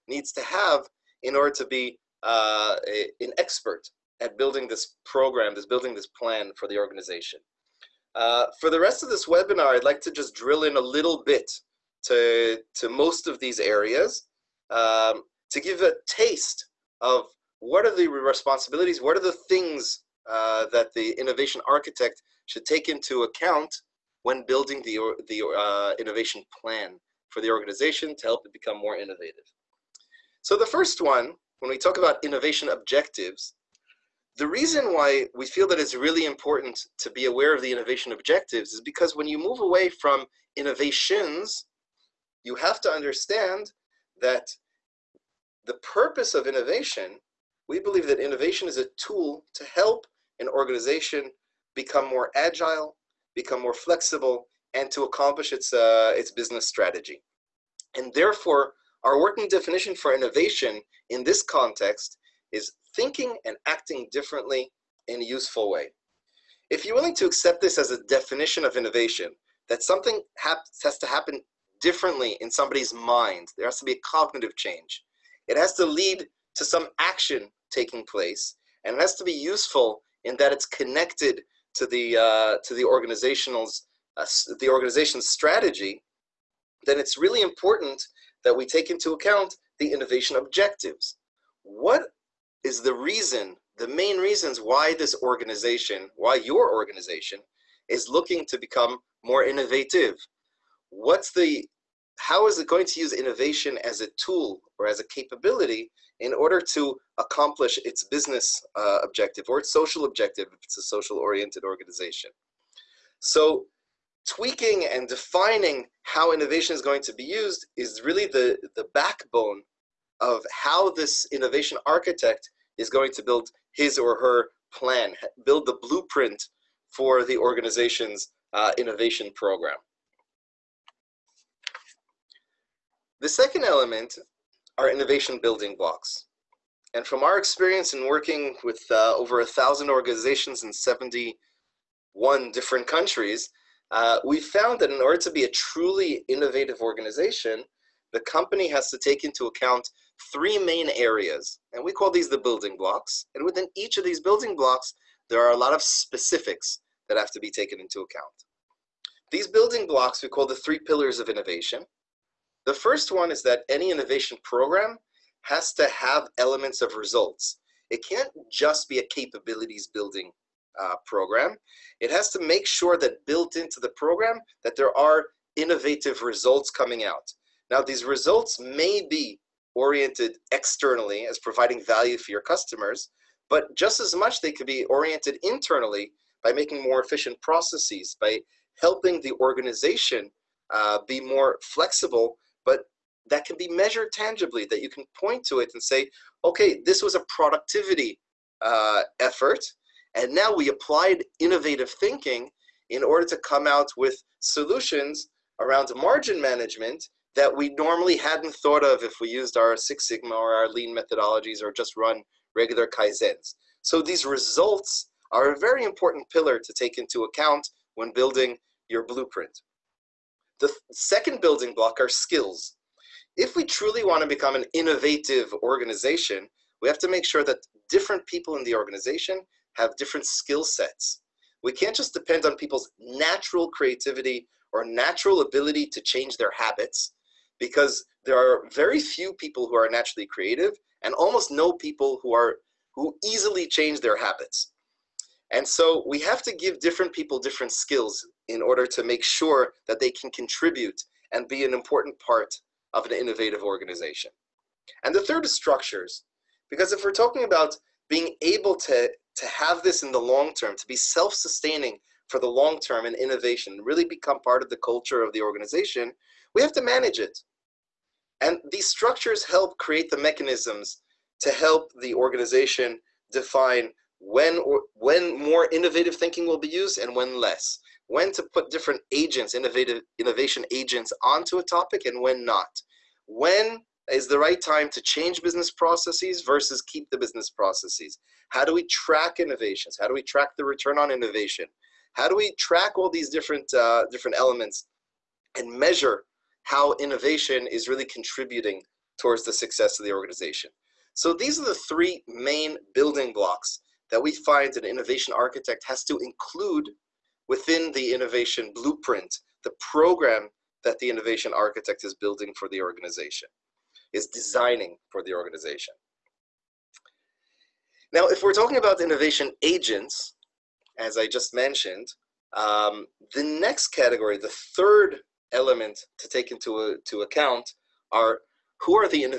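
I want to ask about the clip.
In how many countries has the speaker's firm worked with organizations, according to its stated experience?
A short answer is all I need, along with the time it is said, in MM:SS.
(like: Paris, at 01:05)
71, at 02:20.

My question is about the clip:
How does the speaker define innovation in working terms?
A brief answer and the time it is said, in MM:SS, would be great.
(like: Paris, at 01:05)
Thinking and acting differently in a useful way, at 01:02.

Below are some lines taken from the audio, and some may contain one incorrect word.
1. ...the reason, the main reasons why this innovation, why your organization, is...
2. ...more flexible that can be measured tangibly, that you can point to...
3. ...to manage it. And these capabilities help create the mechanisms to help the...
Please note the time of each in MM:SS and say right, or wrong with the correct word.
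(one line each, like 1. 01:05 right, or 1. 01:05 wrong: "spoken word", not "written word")
1. 01:32 wrong: "organization", not "innovation"
2. 03:11 right
3. 04:26 wrong: "structures", not "capabilities".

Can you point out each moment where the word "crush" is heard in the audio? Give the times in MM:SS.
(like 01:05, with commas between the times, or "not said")
not said.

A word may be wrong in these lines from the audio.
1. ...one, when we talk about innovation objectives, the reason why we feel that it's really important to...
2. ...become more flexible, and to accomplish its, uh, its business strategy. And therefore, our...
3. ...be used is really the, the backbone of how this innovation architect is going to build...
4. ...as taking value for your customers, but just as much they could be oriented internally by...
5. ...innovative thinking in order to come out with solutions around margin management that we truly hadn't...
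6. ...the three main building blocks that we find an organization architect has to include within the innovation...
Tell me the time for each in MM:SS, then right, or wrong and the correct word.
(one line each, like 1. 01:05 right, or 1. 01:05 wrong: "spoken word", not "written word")
1. 00:31 right
2. 00:53 right
3. 01:57 right
4. 03:01 wrong: "providing", not "taking"
5. 03:21 wrong: "normally", not "truly"
6. 05:01 wrong: "innovation", not "organization".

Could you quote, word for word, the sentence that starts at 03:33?
So these results are a very important pillar to take into account when building your blueprint.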